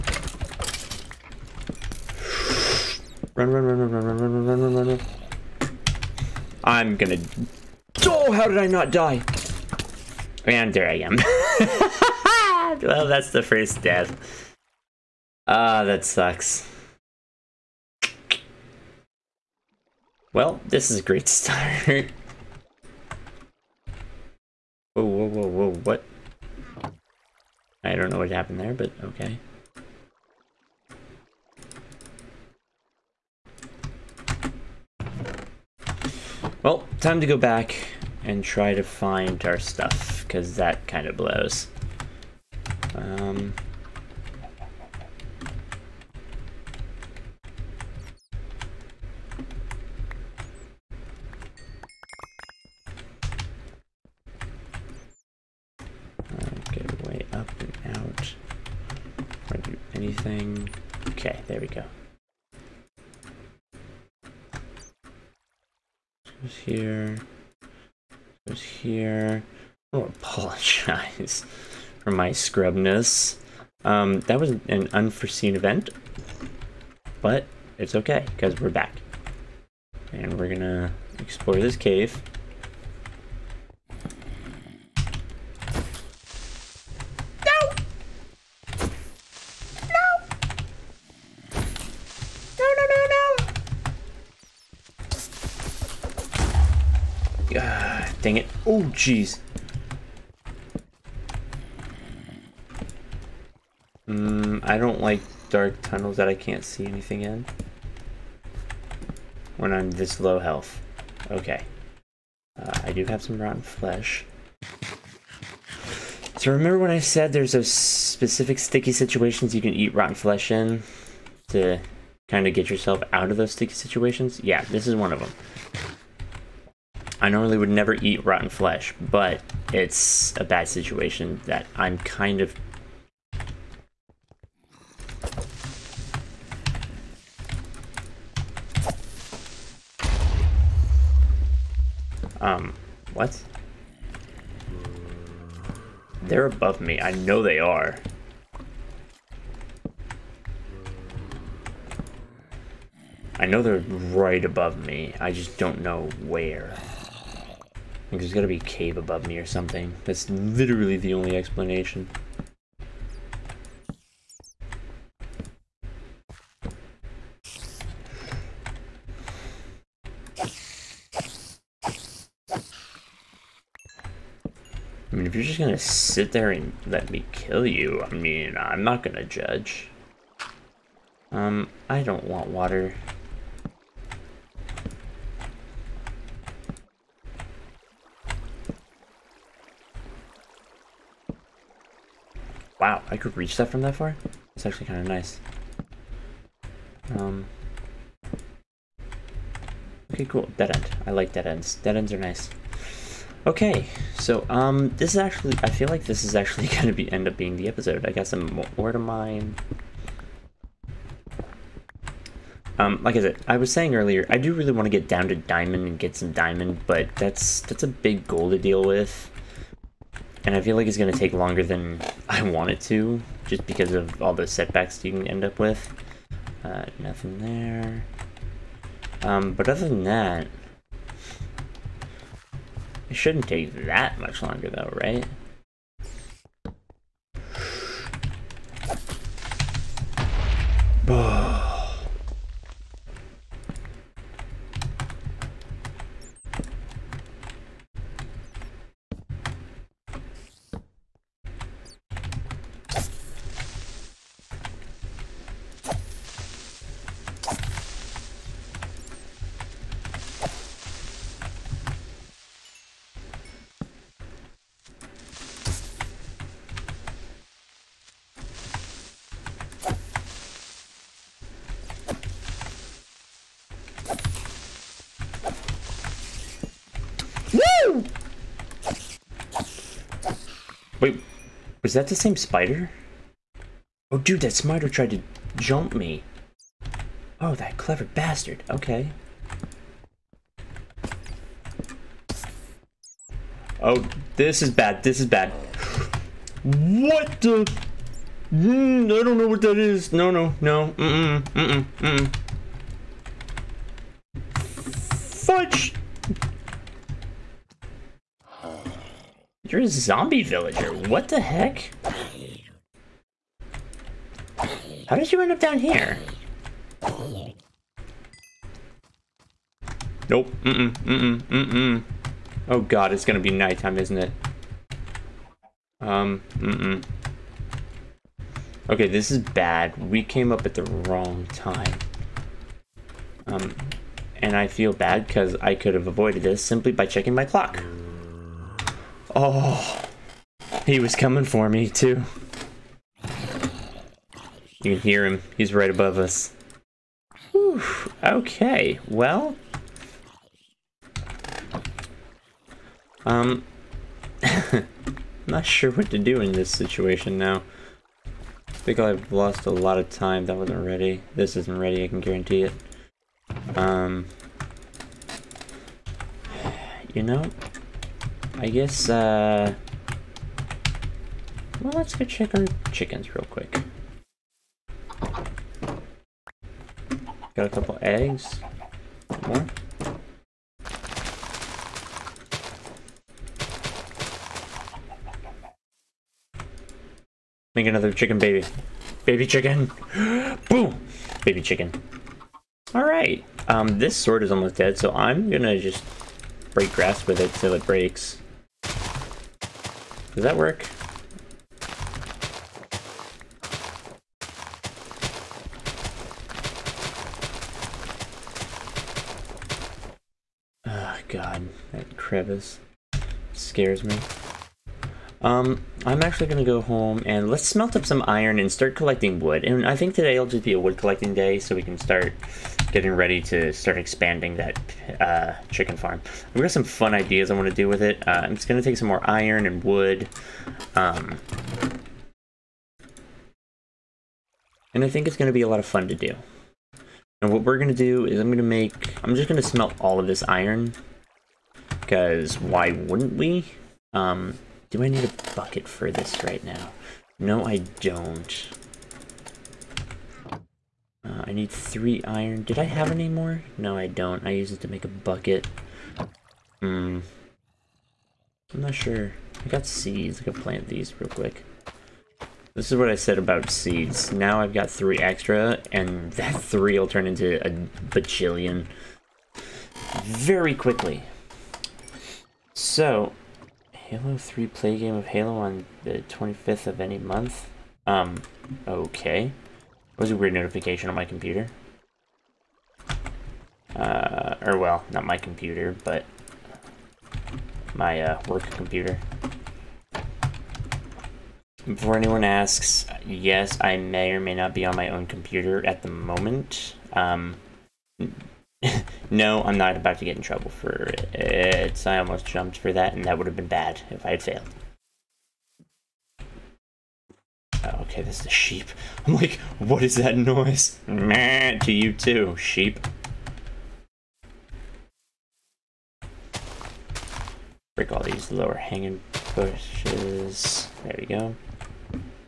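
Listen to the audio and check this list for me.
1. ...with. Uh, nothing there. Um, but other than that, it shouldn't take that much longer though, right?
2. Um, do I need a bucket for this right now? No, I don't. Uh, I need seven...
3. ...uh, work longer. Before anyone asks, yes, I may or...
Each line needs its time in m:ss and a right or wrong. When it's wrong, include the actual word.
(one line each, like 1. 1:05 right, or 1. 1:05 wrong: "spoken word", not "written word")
1. 3:45 right
2. 7:24 wrong: "three", not "seven"
3. 8:08 wrong: "computer", not "longer".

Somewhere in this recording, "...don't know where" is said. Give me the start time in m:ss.
2:35.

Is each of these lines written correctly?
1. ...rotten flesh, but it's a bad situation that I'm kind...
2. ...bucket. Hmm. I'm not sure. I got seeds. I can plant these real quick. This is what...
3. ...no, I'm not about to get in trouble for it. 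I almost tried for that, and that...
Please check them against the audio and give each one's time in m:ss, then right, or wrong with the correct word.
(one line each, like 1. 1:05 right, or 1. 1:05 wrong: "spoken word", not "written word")
1. 2:08 right
2. 7:35 right
3. 8:19 wrong: "jumped", not "tried".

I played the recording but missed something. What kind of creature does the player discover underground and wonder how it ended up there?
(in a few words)
zombie villager.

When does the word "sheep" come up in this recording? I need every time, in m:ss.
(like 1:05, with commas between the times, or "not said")
8:28, 8:32.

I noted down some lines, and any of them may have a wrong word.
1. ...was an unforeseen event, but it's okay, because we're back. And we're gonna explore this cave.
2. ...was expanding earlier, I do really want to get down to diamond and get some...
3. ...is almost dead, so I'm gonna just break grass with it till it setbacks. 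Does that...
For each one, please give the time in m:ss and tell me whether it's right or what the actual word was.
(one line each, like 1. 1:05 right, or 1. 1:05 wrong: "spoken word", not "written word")
1. 1:14 right
2. 3:33 wrong: "saying", not "expanding"
3. 6:34 wrong: "breaks", not "setbacks".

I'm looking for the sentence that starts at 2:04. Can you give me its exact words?
Yeah, this is one of them.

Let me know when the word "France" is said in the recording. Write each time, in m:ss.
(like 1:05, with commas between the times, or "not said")
not said.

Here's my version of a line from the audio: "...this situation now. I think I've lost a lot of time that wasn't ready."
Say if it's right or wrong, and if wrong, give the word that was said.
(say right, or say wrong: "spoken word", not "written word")
right.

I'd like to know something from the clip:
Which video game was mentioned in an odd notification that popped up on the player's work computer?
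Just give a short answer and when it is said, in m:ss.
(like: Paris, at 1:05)
Halo 3, at 7:53.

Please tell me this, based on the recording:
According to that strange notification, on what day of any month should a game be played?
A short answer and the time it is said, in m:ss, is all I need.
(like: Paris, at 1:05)
25th, at 7:56.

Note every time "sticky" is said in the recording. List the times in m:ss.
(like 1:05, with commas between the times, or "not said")
1:58, 2:03.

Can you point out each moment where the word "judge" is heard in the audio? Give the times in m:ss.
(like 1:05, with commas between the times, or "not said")
2:59.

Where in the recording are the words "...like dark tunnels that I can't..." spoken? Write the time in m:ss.
1:45.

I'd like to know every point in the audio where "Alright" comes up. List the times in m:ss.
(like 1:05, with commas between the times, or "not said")
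6:32.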